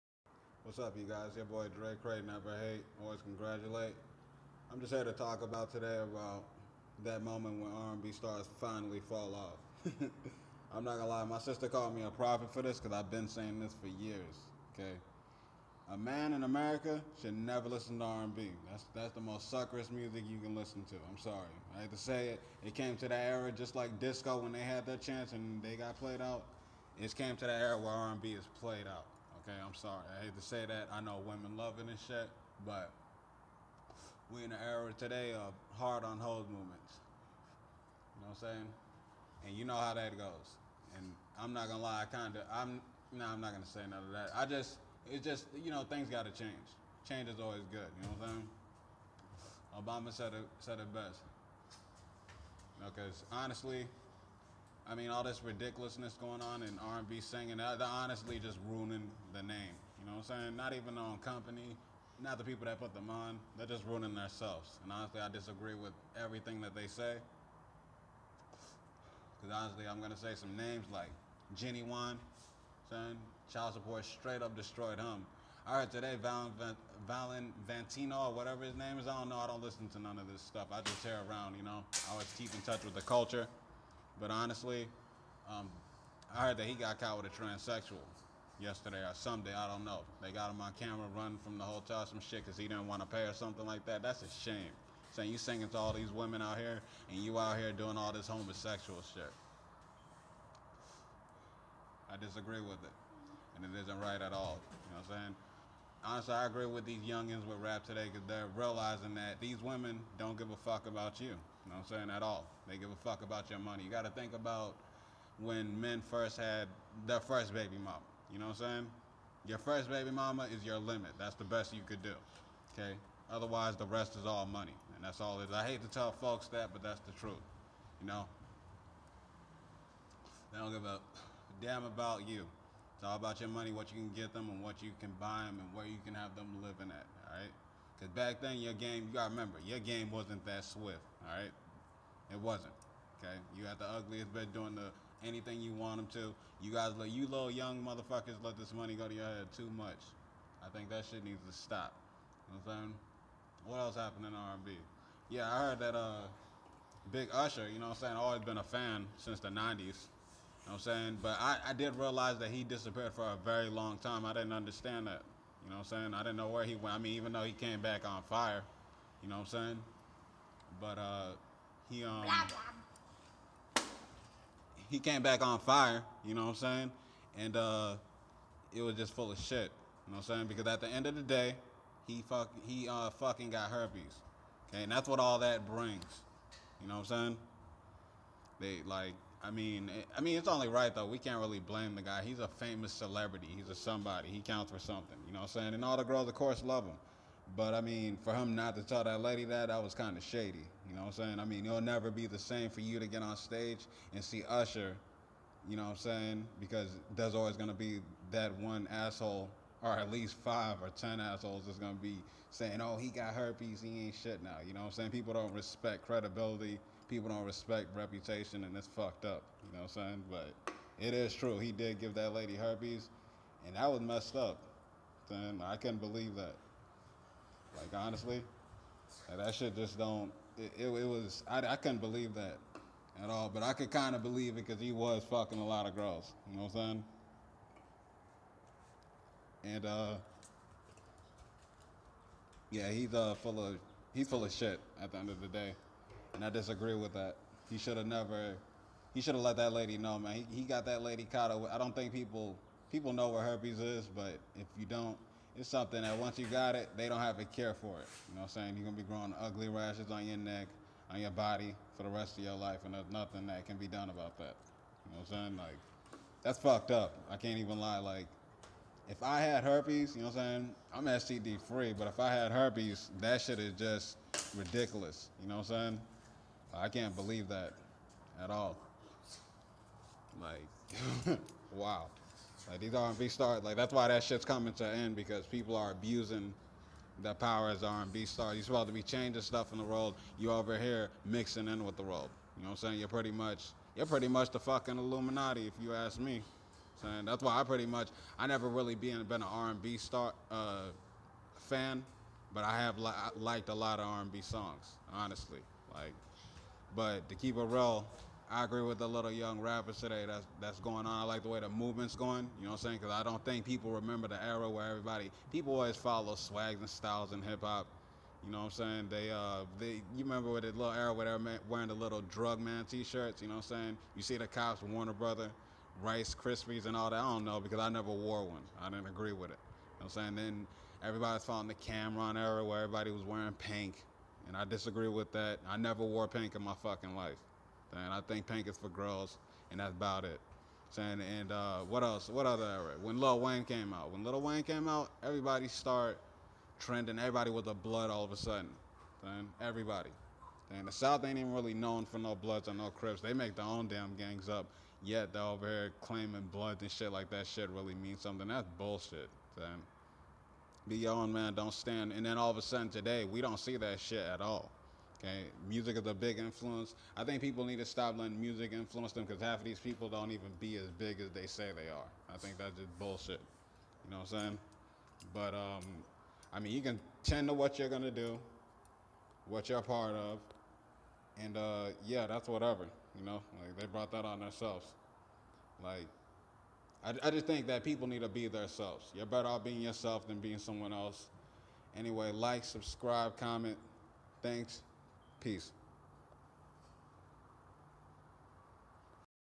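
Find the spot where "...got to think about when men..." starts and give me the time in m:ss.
1:53.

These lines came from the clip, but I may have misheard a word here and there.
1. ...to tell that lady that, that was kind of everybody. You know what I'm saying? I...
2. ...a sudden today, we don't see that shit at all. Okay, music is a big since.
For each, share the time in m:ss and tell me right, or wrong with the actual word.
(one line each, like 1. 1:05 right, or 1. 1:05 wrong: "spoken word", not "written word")
1. 3:18 wrong: "shady", not "everybody"
2. 6:02 wrong: "influence", not "since".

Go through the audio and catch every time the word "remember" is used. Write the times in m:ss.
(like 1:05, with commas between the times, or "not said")
2:19, 5:13, 5:20.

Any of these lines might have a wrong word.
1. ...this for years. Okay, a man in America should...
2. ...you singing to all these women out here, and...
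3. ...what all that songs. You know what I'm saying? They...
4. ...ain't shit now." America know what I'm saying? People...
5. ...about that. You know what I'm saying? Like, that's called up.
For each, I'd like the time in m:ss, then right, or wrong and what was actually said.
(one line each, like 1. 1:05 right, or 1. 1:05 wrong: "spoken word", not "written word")
1. 0:13 right
2. 1:35 right
3. 3:05 wrong: "brings", not "songs"
4. 3:34 wrong: "You", not "America"
5. 4:24 wrong: "fucked", not "called".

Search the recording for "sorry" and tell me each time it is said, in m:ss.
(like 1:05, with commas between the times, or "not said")
0:21, 0:29.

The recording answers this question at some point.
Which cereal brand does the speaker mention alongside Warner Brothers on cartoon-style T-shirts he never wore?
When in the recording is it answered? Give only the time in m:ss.
5:26.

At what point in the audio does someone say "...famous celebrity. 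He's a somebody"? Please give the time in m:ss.
3:12.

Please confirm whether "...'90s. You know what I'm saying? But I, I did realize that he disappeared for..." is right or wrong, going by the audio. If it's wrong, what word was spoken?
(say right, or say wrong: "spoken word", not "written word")
right.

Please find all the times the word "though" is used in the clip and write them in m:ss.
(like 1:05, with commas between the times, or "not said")
2:47, 3:10.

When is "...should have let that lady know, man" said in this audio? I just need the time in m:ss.
4:09.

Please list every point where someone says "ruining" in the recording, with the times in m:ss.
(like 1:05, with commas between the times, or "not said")
0:58, 1:03.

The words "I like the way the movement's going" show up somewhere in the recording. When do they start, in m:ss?
5:11.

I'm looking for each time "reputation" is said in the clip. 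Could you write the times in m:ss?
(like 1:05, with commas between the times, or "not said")
3:37.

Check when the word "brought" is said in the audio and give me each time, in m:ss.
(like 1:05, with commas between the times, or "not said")
6:23.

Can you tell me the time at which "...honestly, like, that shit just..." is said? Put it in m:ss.
3:47.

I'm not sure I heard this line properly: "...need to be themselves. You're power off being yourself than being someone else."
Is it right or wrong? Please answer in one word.
wrong.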